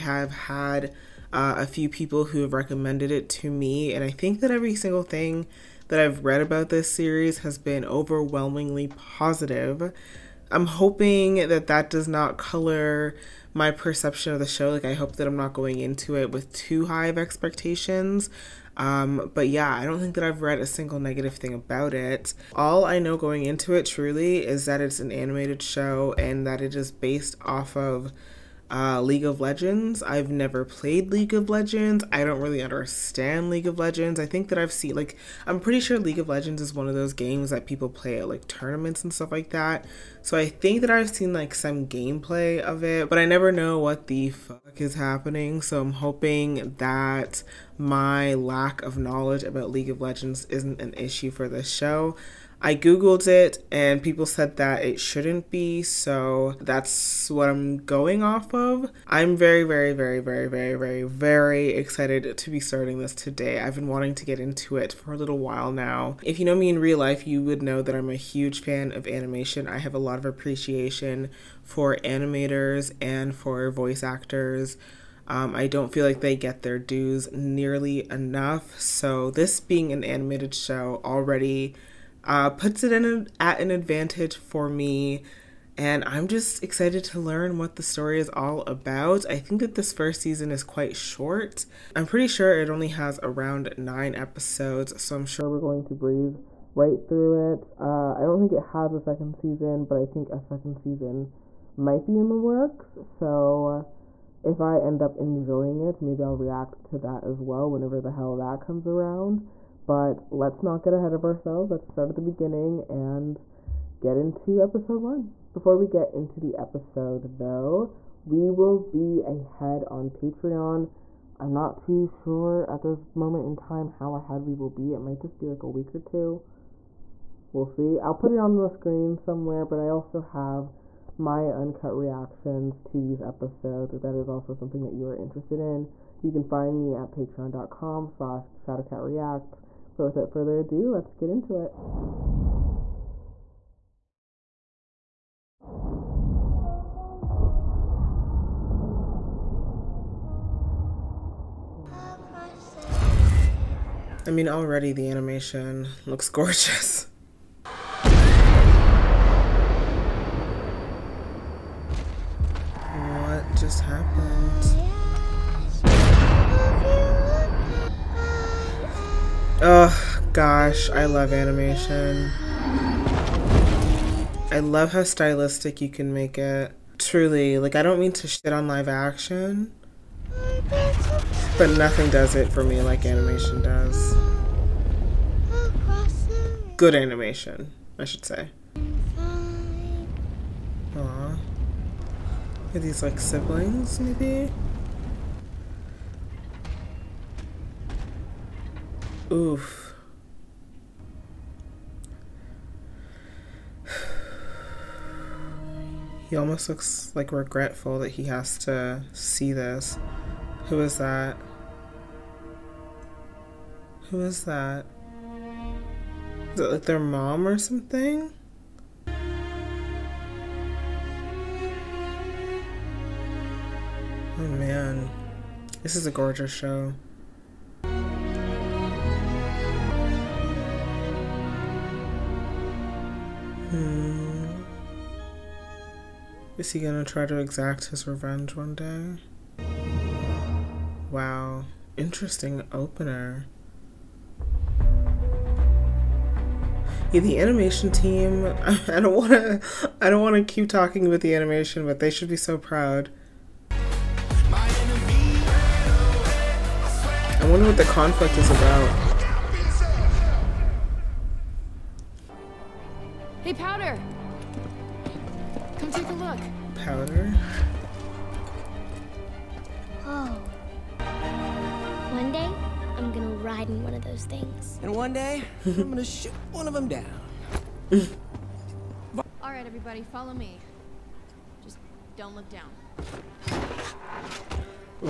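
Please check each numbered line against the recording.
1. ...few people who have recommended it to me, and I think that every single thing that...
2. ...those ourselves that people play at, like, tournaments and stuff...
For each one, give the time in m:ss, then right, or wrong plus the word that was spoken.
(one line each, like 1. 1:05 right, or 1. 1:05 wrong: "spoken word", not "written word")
1. 0:01 right
2. 0:36 wrong: "games", not "ourselves".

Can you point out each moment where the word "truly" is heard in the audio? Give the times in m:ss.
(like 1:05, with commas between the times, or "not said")
0:23, 2:56.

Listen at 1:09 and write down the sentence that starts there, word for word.
I have a lot of appreciation for animators and for voice actors.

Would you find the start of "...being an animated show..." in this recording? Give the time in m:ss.
1:19.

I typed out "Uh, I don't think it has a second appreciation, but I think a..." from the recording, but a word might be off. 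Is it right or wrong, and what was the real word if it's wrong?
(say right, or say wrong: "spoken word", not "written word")
wrong: "season", not "appreciation".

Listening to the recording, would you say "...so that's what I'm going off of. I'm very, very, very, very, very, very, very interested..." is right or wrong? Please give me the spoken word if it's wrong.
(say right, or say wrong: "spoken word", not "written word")
wrong: "excited", not "interested".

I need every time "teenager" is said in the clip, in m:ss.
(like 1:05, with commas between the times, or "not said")
not said.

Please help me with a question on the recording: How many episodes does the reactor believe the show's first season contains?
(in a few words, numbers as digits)
9.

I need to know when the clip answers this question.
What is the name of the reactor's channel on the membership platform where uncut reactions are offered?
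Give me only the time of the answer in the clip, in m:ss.
2:18.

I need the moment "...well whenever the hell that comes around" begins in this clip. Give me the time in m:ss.
1:47.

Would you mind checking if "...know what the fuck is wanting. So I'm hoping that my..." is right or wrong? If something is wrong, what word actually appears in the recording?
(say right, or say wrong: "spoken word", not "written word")
wrong: "happening", not "wanting".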